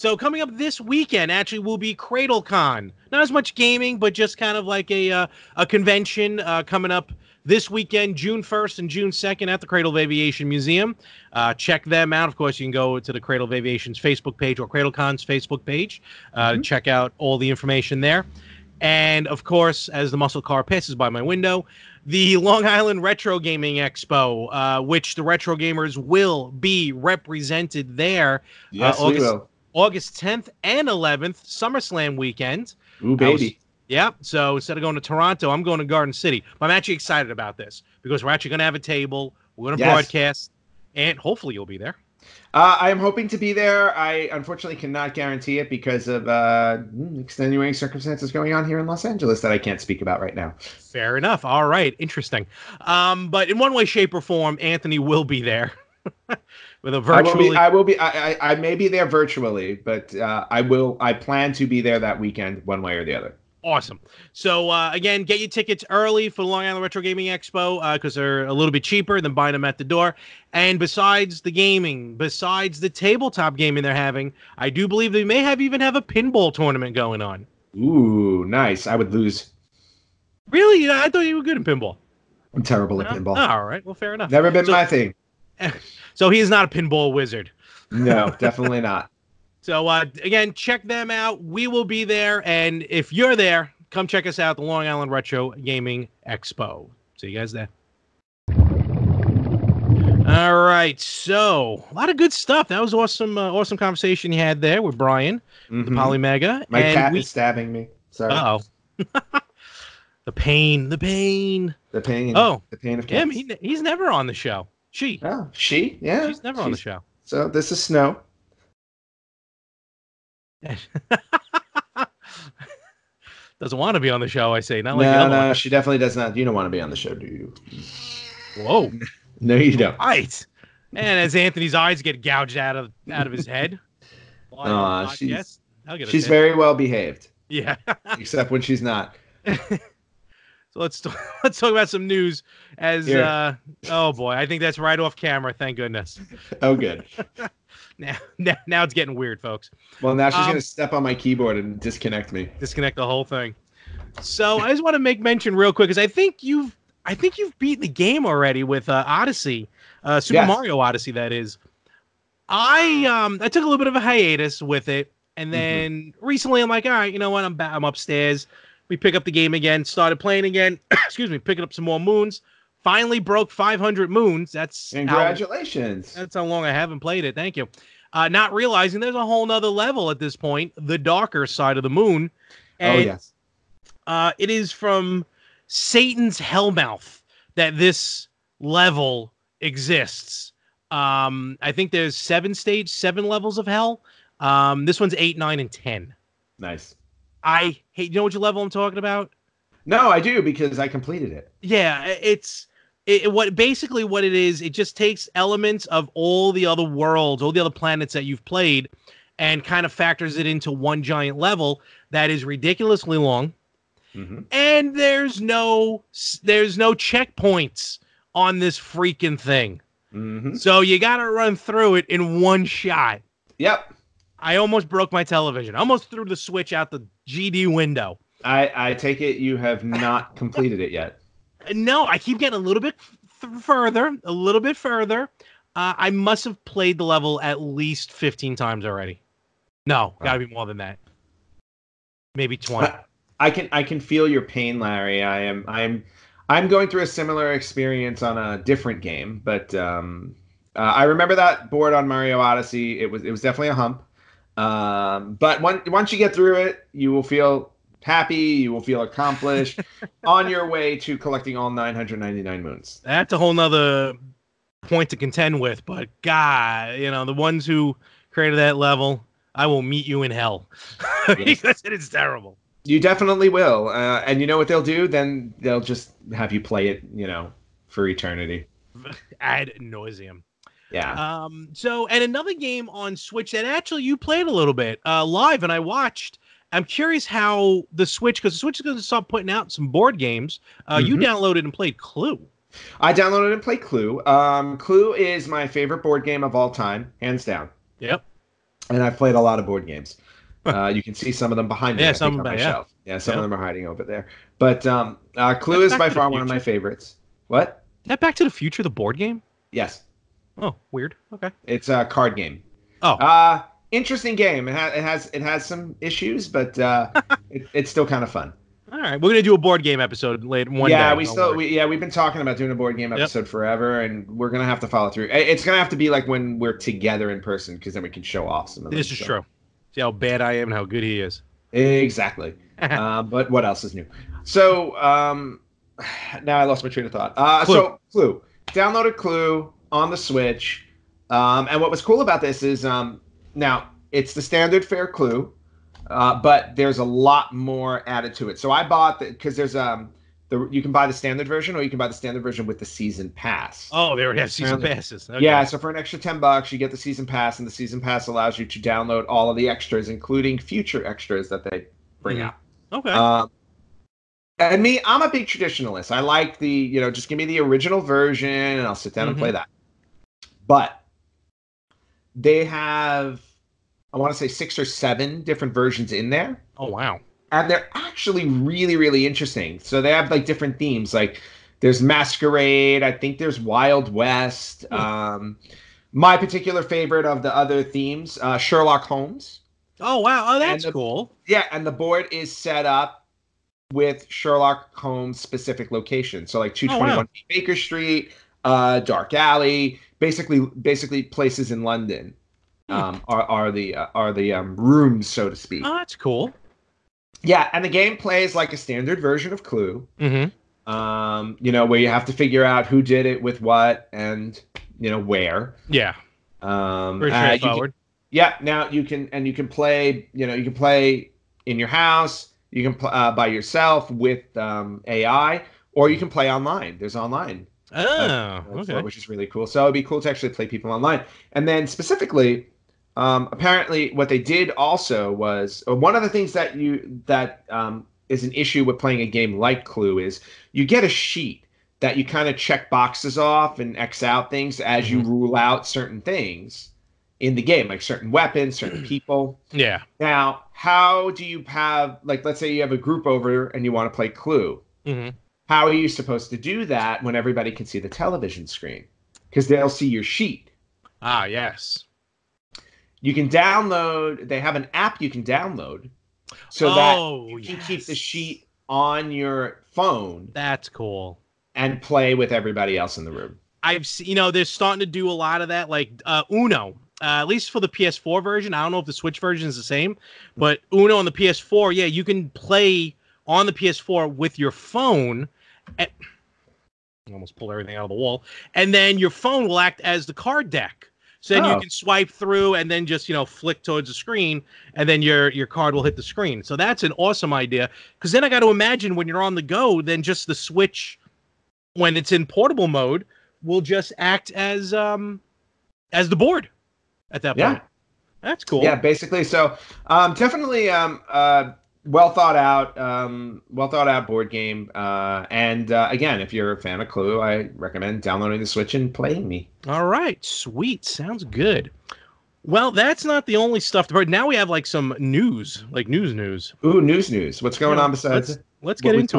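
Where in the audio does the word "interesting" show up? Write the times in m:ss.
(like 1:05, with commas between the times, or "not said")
0:51, 5:13, 6:19.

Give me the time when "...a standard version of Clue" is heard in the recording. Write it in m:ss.
6:48.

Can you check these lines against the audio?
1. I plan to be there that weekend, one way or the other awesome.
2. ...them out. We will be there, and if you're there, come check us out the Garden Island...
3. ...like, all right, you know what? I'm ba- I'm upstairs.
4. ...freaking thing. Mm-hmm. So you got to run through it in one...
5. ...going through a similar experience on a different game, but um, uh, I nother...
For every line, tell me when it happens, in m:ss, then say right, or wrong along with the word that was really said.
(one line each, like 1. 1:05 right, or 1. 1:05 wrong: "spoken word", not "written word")
1. 1:00 right
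2. 1:30 wrong: "Long", not "Garden"
3. 2:46 right
4. 3:38 right
5. 4:06 wrong: "remember", not "nother".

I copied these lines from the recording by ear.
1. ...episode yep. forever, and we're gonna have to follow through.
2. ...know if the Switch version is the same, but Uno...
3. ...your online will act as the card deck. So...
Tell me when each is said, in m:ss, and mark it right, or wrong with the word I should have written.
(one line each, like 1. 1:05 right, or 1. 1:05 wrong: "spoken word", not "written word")
1. 5:23 right
2. 7:58 right
3. 8:09 wrong: "phone", not "online".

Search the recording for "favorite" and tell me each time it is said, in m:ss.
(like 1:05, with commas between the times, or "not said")
4:55, 5:06, 6:26.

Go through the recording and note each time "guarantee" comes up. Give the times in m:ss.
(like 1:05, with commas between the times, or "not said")
0:45.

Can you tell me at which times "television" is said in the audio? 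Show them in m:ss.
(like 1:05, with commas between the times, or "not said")
3:45, 7:38.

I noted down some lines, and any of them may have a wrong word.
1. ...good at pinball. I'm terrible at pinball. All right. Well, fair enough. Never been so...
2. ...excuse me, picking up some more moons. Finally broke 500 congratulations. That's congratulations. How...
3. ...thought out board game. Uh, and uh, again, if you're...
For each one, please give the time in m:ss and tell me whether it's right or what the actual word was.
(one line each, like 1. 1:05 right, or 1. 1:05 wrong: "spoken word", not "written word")
1. 1:21 right
2. 2:50 wrong: "moons", not "congratulations"
3. 8:33 right.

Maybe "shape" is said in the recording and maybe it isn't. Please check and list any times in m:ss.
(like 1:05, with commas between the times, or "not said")
0:53.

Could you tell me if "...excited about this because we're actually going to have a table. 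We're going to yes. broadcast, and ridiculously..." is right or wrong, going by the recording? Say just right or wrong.
wrong.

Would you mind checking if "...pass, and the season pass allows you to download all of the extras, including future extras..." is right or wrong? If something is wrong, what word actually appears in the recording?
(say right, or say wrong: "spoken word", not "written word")
right.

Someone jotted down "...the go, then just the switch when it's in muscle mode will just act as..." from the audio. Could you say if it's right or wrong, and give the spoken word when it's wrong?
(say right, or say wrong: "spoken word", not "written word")
wrong: "portable", not "muscle".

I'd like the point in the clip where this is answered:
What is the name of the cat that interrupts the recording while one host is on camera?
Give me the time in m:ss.
1:57.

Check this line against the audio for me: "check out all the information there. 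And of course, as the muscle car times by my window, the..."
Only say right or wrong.
wrong.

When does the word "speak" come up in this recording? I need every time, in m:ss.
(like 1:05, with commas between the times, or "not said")
0:49, 6:45.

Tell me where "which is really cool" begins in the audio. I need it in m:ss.
7:09.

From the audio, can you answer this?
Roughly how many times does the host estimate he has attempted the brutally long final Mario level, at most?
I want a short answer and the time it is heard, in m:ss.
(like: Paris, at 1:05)
20, at 4:02.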